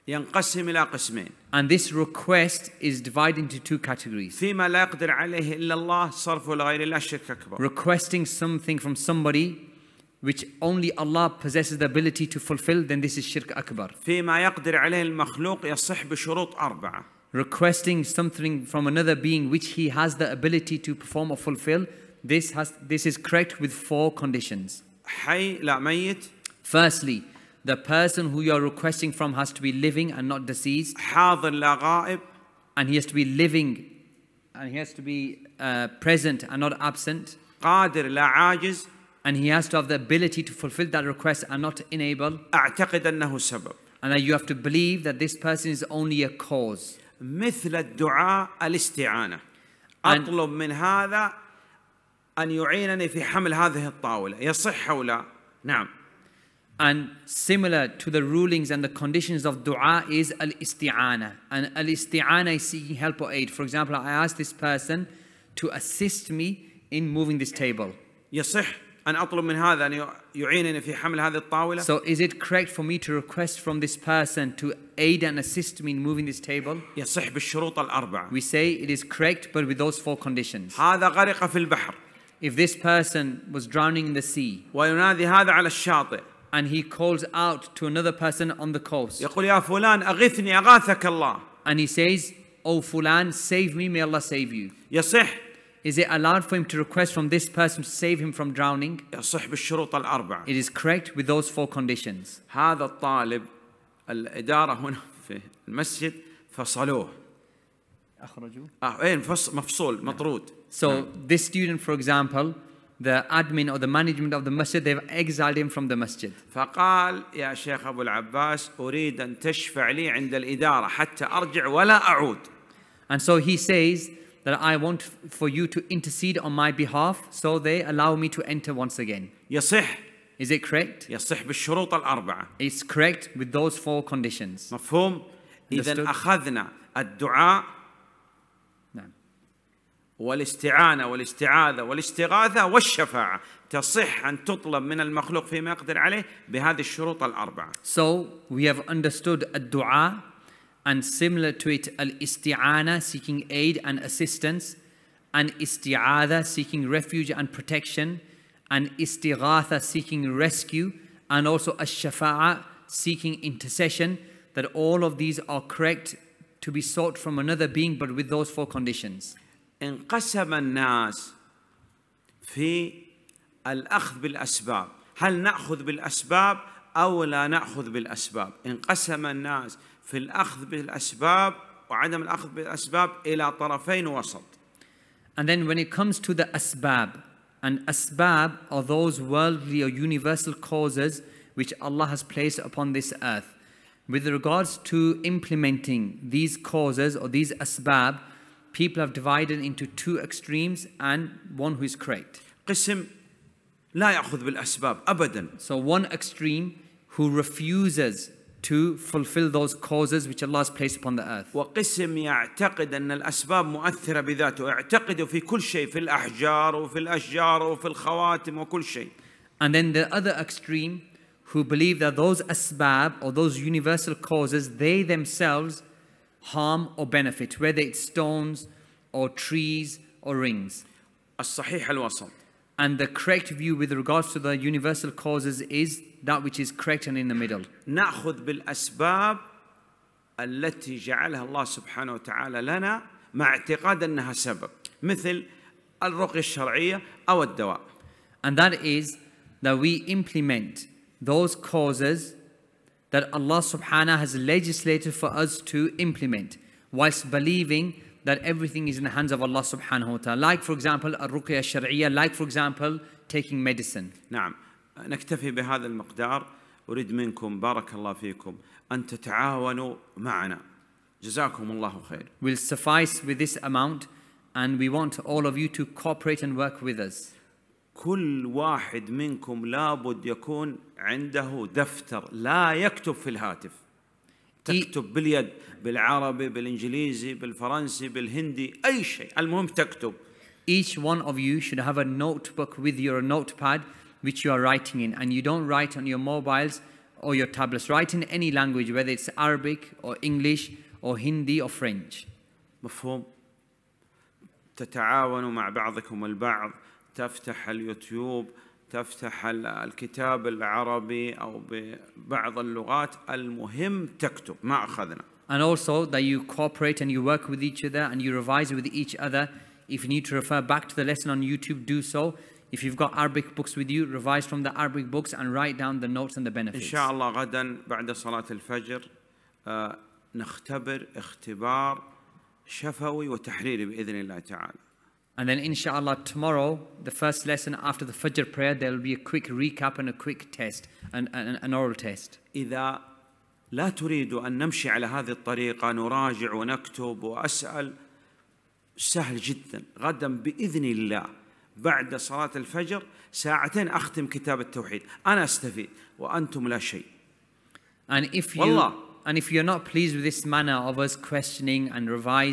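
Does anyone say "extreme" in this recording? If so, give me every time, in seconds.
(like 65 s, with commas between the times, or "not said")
200 s, 206 s, 220 s.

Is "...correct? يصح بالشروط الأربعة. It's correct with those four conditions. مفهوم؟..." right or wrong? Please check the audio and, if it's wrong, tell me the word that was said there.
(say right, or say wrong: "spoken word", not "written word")
right.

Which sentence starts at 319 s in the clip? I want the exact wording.
If you need to refer back to the lesson on YouTube, do so.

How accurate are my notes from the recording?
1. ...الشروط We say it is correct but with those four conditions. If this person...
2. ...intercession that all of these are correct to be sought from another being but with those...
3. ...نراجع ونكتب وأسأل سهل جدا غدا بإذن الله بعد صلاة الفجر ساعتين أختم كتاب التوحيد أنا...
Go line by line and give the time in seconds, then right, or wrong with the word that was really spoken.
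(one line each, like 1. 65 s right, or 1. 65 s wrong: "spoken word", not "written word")
1. 77 s wrong: "بالشروط", not "الشروط"
2. 163 s right
3. 345 s right.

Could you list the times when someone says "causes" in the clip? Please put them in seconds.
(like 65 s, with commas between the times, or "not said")
46 s, 190 s, 196 s, 209 s, 224 s, 235 s, 251 s.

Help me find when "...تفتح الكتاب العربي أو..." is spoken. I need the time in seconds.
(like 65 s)
308 s.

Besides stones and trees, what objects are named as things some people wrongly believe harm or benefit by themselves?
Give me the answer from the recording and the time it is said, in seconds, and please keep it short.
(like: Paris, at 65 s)
Rings, at 230 s.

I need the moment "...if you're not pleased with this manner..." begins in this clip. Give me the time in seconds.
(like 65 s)
359 s.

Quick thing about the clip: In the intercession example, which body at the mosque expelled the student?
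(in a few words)
The management.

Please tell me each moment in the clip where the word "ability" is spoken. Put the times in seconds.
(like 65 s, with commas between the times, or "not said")
11 s, 20 s, 39 s.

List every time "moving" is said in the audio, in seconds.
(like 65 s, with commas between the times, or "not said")
67 s, 75 s.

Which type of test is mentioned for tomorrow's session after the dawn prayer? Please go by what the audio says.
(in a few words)
Oral test.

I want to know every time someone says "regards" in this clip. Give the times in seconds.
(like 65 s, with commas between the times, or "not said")
194 s, 233 s.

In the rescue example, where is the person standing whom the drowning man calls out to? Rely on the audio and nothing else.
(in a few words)
On the coast.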